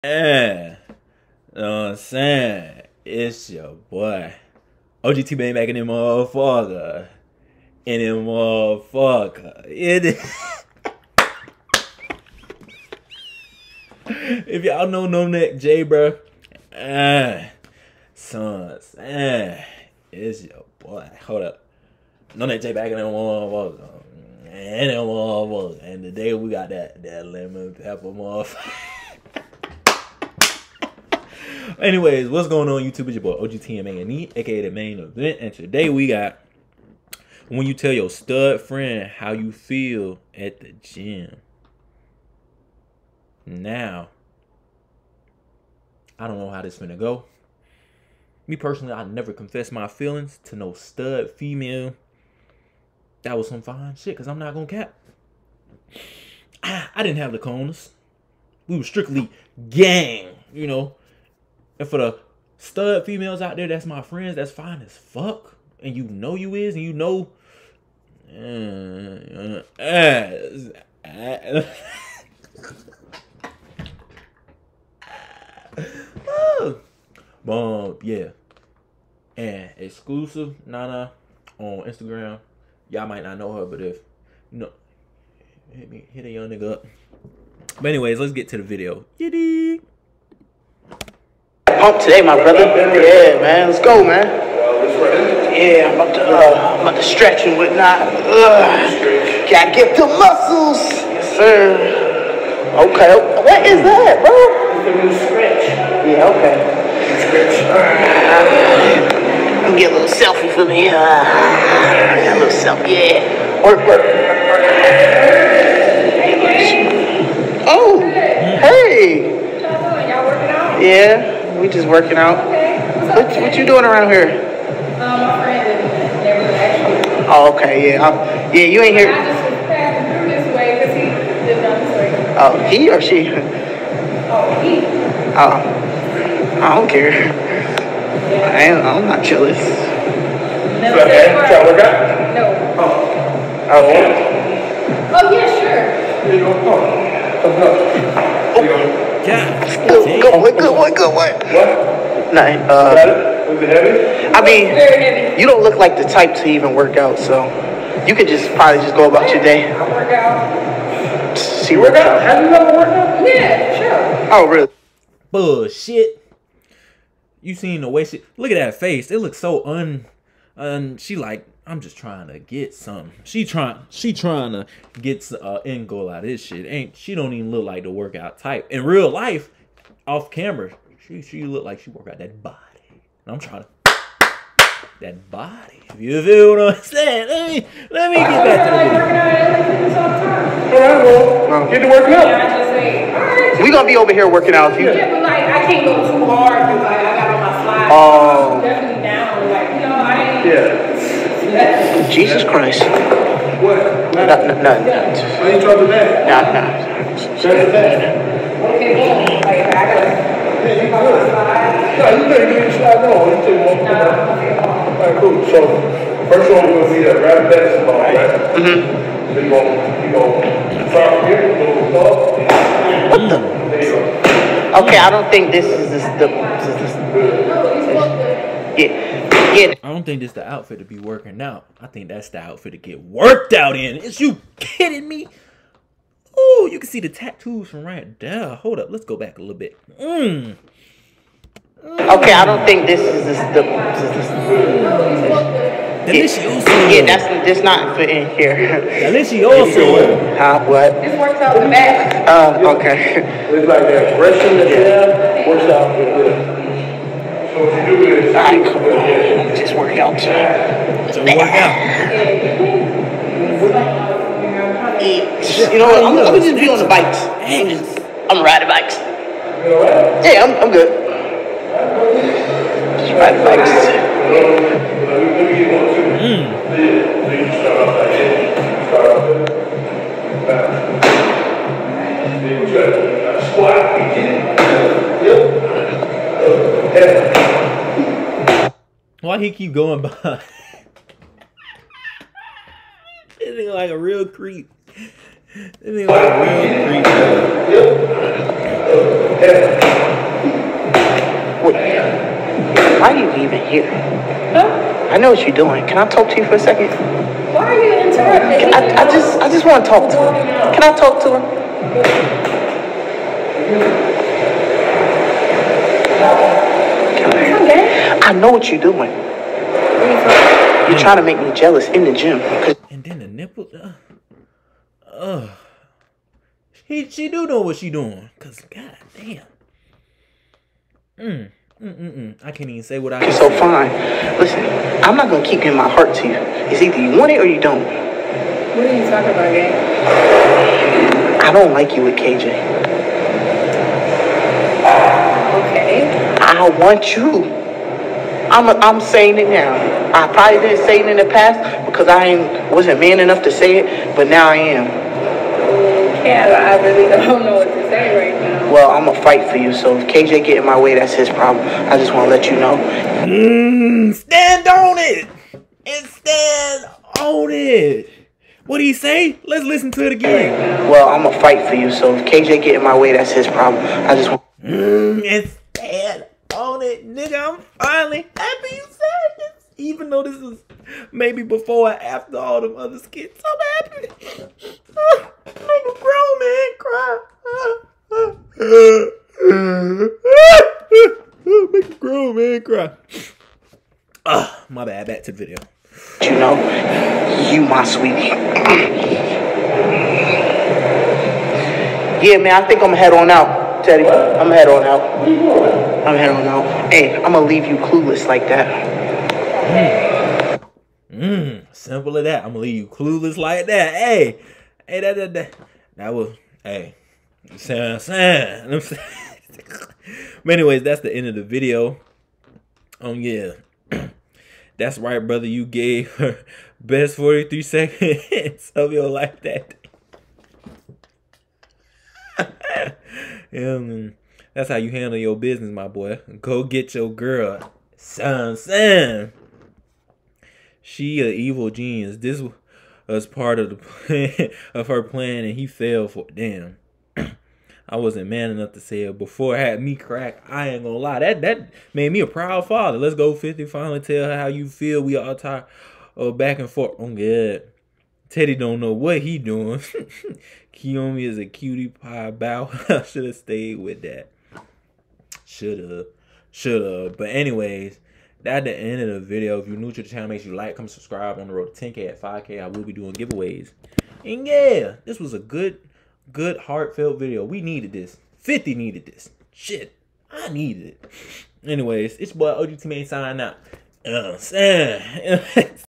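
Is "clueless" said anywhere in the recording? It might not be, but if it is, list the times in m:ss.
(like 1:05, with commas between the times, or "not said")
6:47, 6:52.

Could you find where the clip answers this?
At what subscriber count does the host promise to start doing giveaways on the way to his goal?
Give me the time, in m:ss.
7:52.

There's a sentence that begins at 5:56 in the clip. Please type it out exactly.
Yeah, I really don't know what to say right now.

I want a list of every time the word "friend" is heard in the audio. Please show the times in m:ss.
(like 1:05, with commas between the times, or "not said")
0:38, 1:04.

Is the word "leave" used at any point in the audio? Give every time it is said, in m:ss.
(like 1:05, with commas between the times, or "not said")
6:47, 6:52.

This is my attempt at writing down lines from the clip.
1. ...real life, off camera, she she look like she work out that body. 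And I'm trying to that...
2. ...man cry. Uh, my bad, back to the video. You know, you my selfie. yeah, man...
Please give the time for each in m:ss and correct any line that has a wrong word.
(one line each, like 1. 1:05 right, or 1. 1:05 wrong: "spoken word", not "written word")
1. 2:58 right
2. 6:32 wrong: "sweetie", not "selfie".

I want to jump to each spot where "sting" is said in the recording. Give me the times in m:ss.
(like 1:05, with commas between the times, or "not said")
not said.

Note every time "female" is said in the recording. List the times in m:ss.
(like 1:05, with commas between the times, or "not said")
0:51, 1:03.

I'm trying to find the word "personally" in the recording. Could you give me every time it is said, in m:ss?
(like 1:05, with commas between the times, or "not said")
0:48.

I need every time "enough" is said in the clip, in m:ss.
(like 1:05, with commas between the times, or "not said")
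5:53, 7:28.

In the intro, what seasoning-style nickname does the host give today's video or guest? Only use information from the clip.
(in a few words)
Lemon pepper.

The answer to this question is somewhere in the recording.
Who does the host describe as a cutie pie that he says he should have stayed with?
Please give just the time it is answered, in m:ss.
7:40.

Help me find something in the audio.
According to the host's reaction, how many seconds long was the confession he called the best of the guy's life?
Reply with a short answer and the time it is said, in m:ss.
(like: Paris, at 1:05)
43, at 7:07.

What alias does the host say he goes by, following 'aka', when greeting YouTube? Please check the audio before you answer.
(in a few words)
The main event.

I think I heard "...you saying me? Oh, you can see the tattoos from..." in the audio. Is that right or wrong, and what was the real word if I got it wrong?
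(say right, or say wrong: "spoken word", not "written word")
wrong: "kidding", not "saying".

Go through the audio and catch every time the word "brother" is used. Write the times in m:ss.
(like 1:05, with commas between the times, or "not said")
1:32, 7:05.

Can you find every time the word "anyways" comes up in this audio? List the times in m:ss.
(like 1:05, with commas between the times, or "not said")
0:31, 1:27, 7:00, 7:47, 8:01.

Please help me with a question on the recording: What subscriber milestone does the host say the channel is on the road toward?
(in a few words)
10K.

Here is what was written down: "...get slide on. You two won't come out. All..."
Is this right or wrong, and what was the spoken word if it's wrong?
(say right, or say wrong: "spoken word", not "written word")
right.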